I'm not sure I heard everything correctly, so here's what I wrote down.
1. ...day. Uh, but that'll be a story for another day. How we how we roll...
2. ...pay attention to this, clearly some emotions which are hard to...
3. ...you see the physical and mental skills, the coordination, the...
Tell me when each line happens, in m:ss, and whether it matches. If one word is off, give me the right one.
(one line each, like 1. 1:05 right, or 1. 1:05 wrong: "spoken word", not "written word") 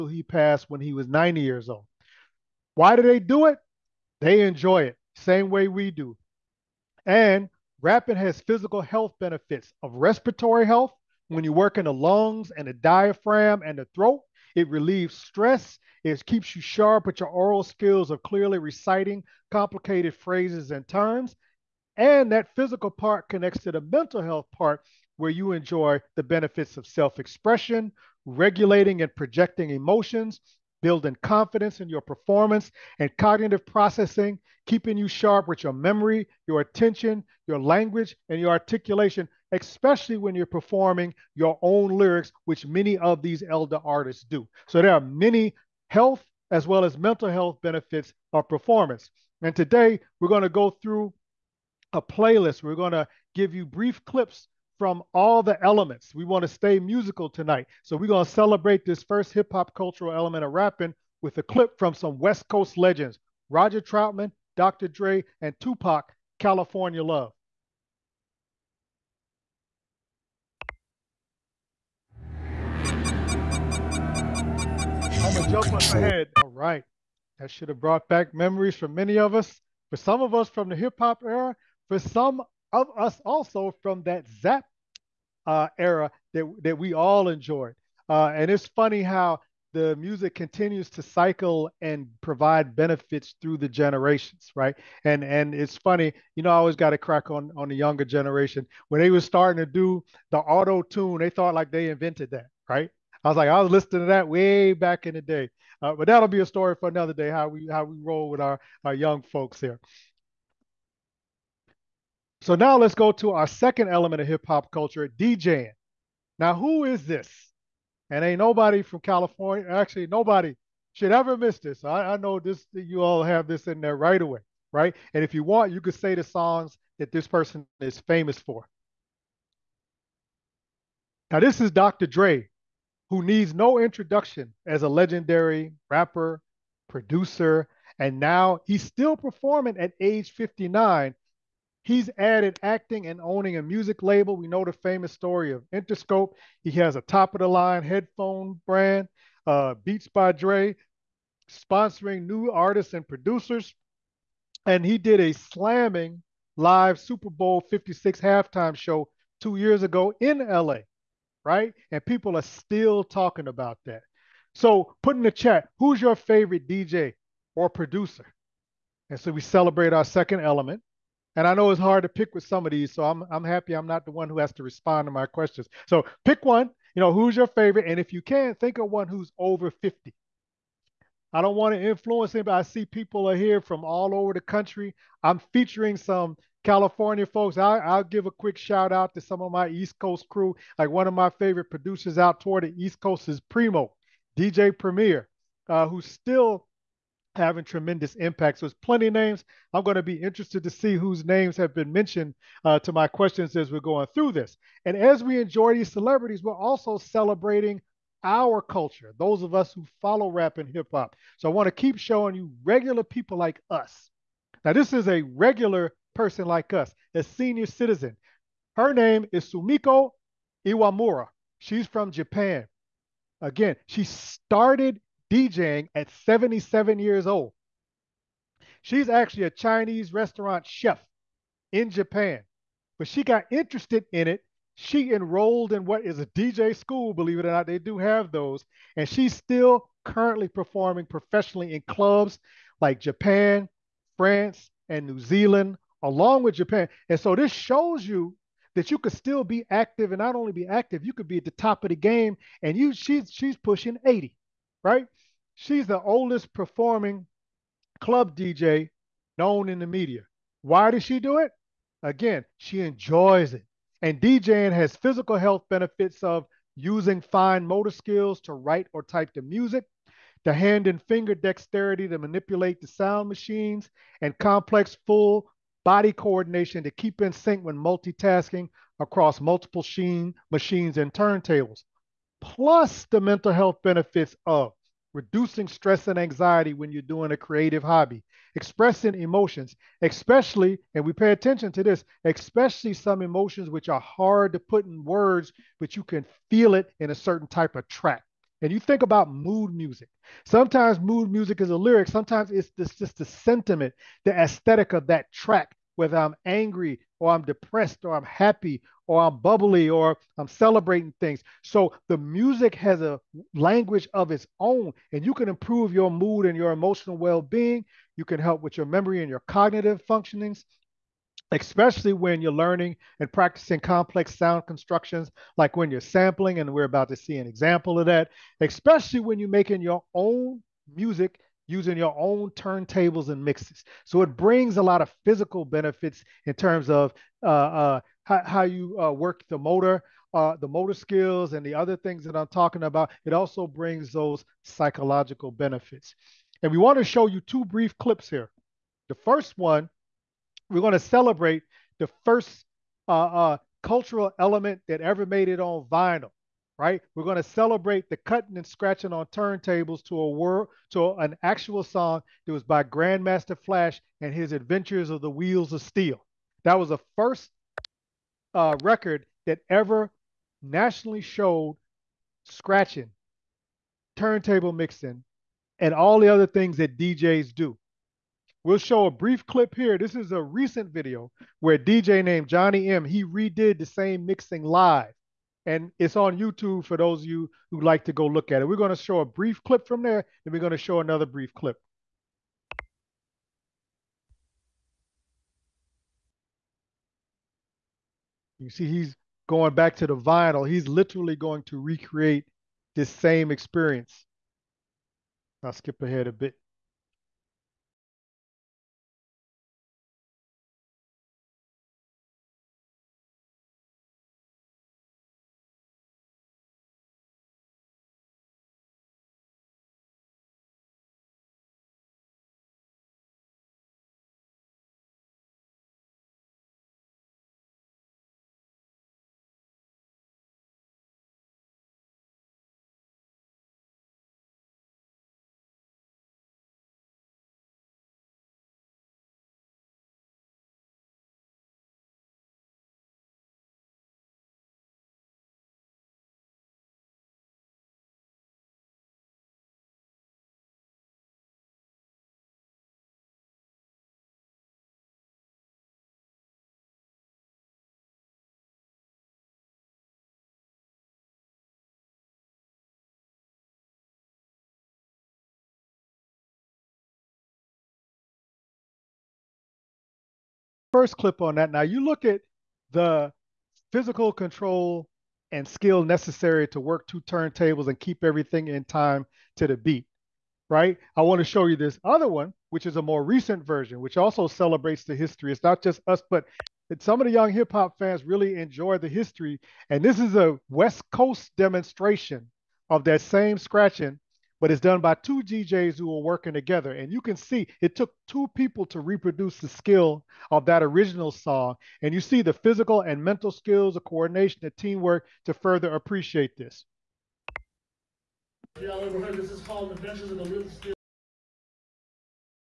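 1. 1:45 right
2. 4:51 wrong: "especially", not "clearly"
3. 8:22 right.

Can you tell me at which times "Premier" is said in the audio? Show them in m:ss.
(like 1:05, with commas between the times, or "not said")
3:14.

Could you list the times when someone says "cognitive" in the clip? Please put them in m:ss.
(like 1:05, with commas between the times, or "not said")
0:33, 5:19.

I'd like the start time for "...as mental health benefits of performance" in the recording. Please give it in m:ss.
0:46.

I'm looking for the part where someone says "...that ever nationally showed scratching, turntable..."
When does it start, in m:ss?
6:09.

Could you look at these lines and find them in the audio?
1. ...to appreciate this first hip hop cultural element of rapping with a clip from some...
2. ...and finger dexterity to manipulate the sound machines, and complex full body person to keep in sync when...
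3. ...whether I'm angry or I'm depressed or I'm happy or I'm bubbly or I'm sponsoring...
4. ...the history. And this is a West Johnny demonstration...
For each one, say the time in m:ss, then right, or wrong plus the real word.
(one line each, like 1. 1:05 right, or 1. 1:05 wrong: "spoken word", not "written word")
1. 0:58 wrong: "celebrate", not "appreciate"
2. 4:30 wrong: "coordination", not "person"
3. 5:05 wrong: "celebrating", not "sponsoring"
4. 8:08 wrong: "Coast", not "Johnny".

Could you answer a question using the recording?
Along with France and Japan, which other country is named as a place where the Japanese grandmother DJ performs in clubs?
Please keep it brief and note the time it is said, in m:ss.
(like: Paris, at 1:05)
New Zealand, at 4:05.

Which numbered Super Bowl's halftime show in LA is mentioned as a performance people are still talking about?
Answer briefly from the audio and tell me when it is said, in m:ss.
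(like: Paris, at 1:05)
Super Bowl 56, at 2:36.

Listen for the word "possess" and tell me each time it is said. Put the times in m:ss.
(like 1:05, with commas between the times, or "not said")
not said.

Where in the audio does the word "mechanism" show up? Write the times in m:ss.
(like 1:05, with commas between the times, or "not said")
not said.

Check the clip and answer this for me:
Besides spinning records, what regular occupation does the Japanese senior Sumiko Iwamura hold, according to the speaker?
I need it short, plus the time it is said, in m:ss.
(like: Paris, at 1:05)
Chinese restaurant chef, at 3:49.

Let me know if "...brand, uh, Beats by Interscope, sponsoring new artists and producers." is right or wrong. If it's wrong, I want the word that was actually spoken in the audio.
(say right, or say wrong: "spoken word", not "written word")
wrong: "Dre", not "Interscope".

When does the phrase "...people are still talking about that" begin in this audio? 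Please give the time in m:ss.
2:42.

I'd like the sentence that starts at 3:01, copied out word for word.
I don't want to influence anybody.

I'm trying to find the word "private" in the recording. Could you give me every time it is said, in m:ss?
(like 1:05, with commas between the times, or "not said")
not said.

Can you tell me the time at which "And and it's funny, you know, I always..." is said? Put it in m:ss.
1:35.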